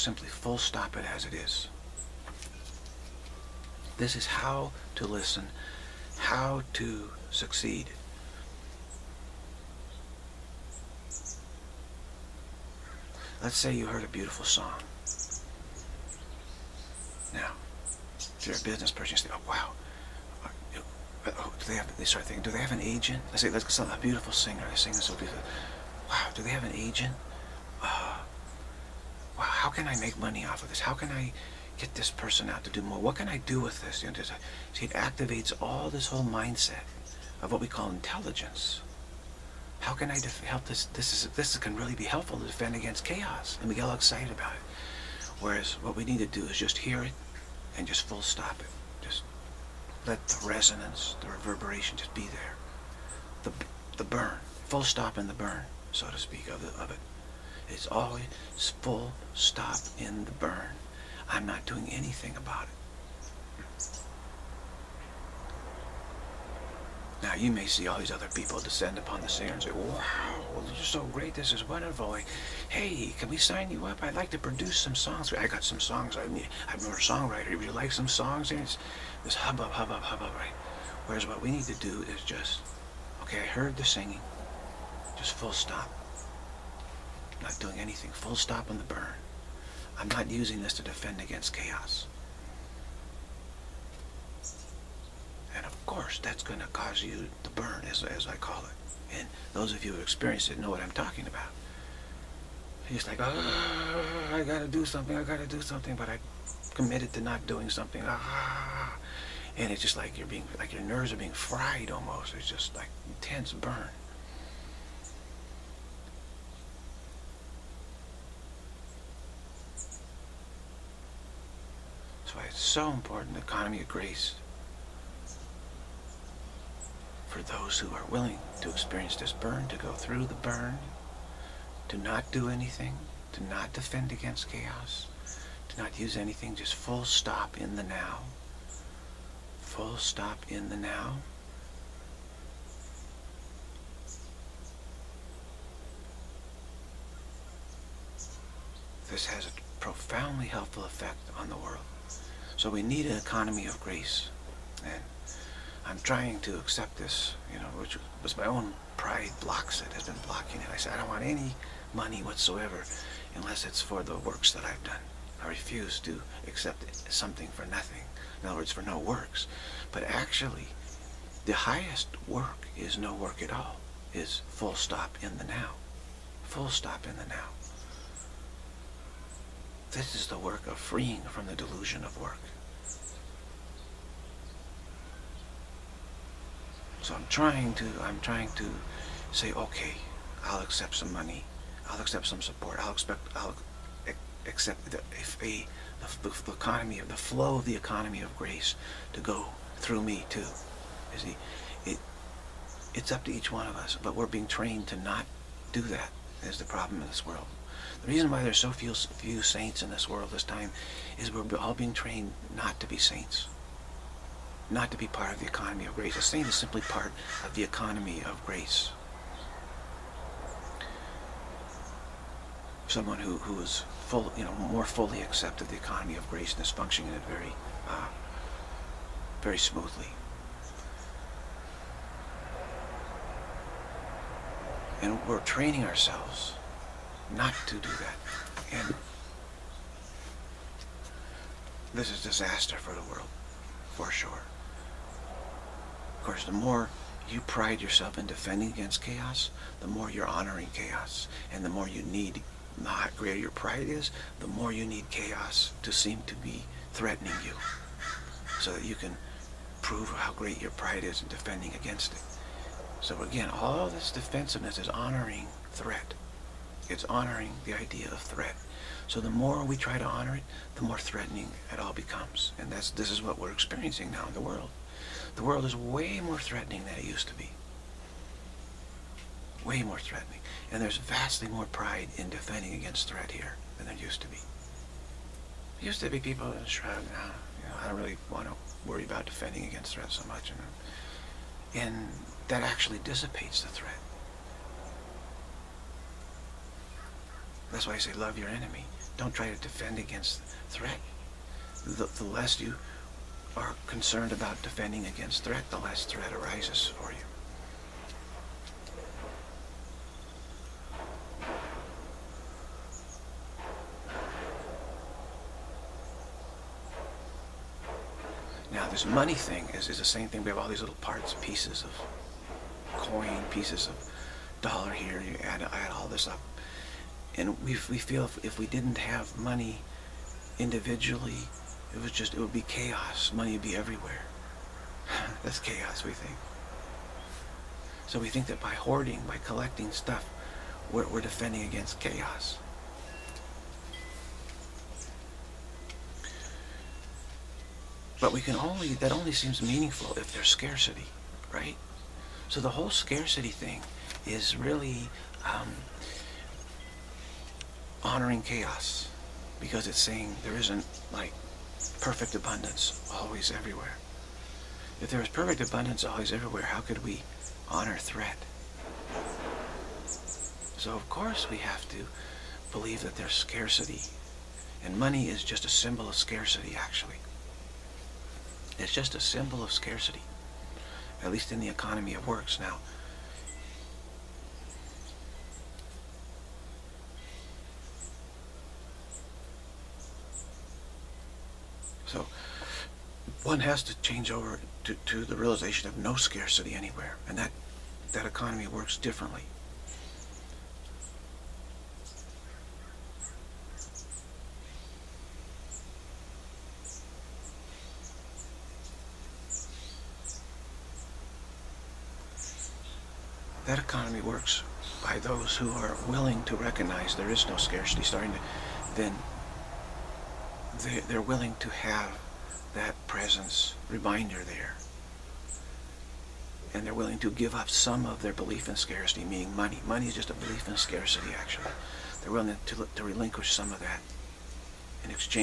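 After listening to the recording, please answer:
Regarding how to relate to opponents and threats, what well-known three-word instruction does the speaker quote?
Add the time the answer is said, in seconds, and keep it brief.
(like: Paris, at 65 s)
love your enemy, at 298 s.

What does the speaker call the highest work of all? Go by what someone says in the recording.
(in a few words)
no work at all.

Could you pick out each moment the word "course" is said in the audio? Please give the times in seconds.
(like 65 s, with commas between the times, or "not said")
95 s, 246 s, 371 s.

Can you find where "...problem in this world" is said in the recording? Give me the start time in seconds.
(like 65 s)
206 s.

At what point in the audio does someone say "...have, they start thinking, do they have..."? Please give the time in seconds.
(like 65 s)
21 s.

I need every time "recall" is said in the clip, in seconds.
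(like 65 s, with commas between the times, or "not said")
not said.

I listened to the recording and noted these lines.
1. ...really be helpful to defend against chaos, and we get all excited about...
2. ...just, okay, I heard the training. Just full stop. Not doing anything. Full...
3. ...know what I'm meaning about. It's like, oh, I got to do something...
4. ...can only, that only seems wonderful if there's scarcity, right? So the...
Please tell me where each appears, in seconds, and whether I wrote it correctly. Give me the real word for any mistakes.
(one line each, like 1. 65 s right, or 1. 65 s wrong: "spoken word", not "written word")
1. 41 s right
2. 82 s wrong: "singing", not "training"
3. 100 s wrong: "talking", not "meaning"
4. 348 s wrong: "meaningful", not "wonderful".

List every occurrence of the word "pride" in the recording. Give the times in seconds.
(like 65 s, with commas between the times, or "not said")
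158 s, 247 s, 253 s, 260 s, 281 s.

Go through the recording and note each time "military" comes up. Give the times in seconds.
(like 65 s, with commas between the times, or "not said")
not said.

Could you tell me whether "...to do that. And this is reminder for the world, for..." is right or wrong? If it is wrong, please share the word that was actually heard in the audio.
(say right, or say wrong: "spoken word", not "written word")
wrong: "disaster", not "reminder".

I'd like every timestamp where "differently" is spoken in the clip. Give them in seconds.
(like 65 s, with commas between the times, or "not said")
398 s.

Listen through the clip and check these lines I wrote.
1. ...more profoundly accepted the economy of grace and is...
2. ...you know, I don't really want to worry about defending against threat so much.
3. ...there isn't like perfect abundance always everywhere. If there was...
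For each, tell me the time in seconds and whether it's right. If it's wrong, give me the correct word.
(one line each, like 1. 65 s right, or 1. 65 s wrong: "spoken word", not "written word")
1. 224 s wrong: "fully", not "profoundly"
2. 287 s right
3. 360 s right.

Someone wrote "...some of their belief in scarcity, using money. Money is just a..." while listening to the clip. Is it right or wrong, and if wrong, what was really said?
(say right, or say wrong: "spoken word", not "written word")
wrong: "meaning", not "using".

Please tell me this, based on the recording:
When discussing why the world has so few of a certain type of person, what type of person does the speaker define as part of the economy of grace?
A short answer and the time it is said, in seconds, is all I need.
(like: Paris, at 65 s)
saint, at 216 s.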